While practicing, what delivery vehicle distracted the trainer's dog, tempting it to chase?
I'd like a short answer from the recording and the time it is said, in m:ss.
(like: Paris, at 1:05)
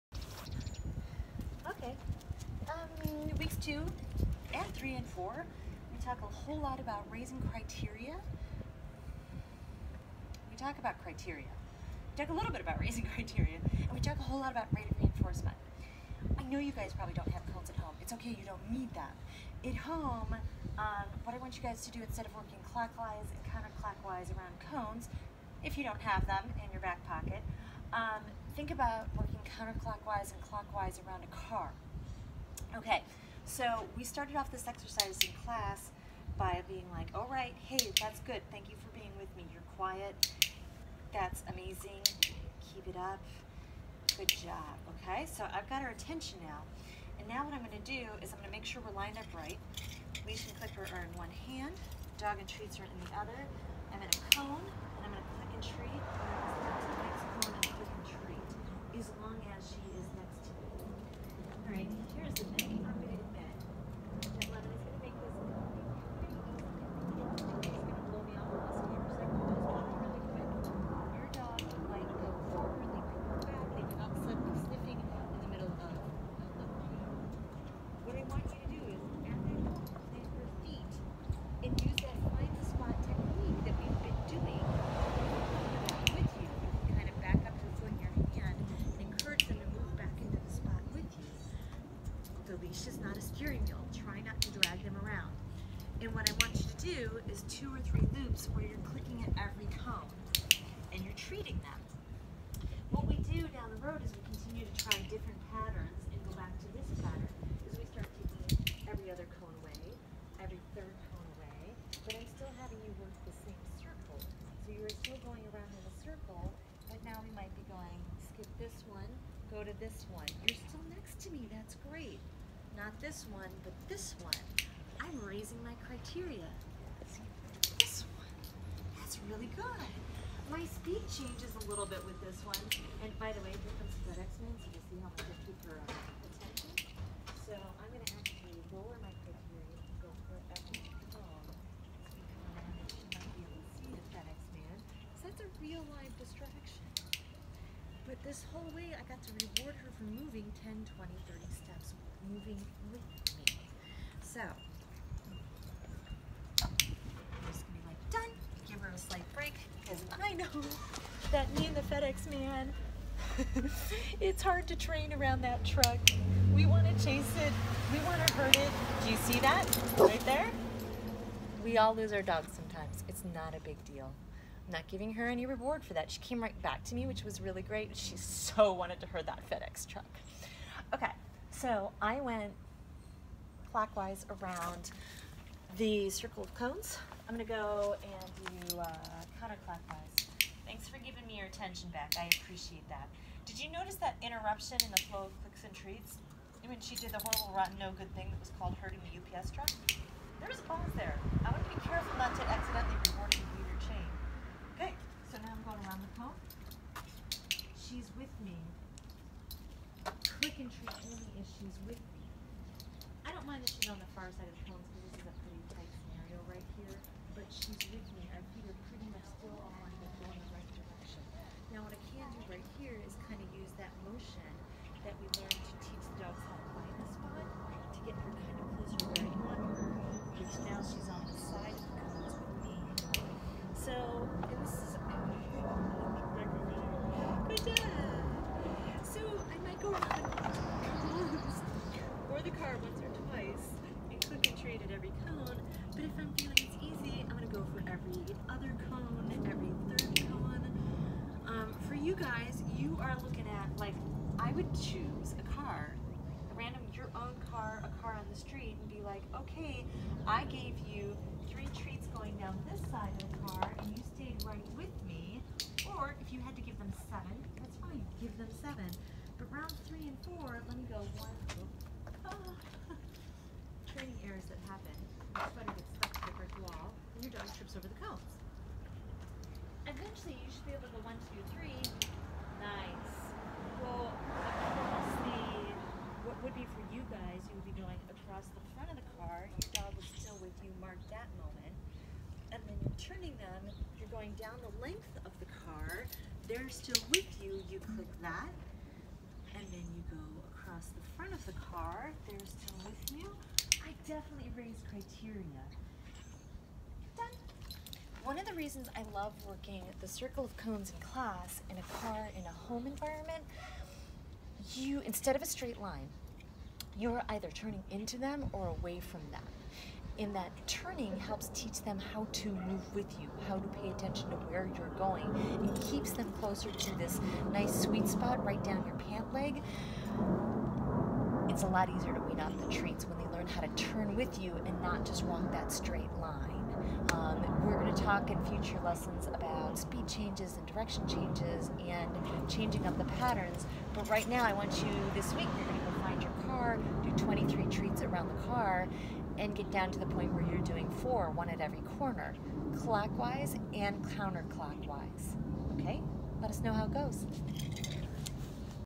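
FedEx truck, at 2:59.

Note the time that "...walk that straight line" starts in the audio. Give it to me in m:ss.
5:35.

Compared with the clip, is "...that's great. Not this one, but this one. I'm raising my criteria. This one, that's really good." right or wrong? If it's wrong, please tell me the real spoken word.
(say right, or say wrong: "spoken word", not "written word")
right.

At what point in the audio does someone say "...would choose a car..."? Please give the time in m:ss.
4:14.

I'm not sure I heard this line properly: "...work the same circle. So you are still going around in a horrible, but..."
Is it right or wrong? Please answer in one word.
wrong.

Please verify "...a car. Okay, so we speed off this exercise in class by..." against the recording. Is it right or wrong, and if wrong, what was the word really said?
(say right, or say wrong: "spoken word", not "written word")
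wrong: "started", not "speed".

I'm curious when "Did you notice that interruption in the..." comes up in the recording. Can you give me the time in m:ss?
3:13.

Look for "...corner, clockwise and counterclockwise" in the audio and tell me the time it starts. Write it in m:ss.
5:51.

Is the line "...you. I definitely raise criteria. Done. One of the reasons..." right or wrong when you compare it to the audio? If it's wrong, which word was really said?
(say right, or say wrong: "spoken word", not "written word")
right.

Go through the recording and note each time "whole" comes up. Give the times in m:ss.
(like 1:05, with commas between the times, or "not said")
0:06, 0:14, 2:28.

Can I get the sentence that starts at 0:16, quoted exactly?
I know you guys probably don't have cones at home.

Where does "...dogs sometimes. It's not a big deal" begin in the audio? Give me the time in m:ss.
2:52.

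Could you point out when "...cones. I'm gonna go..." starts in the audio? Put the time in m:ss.
3:06.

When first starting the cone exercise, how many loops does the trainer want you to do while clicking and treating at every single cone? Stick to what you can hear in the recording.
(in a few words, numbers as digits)
two or three.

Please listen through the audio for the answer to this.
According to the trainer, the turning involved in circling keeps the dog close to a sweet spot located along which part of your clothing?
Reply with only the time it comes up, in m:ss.
5:28.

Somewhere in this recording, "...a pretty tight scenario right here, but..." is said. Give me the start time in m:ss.
3:35.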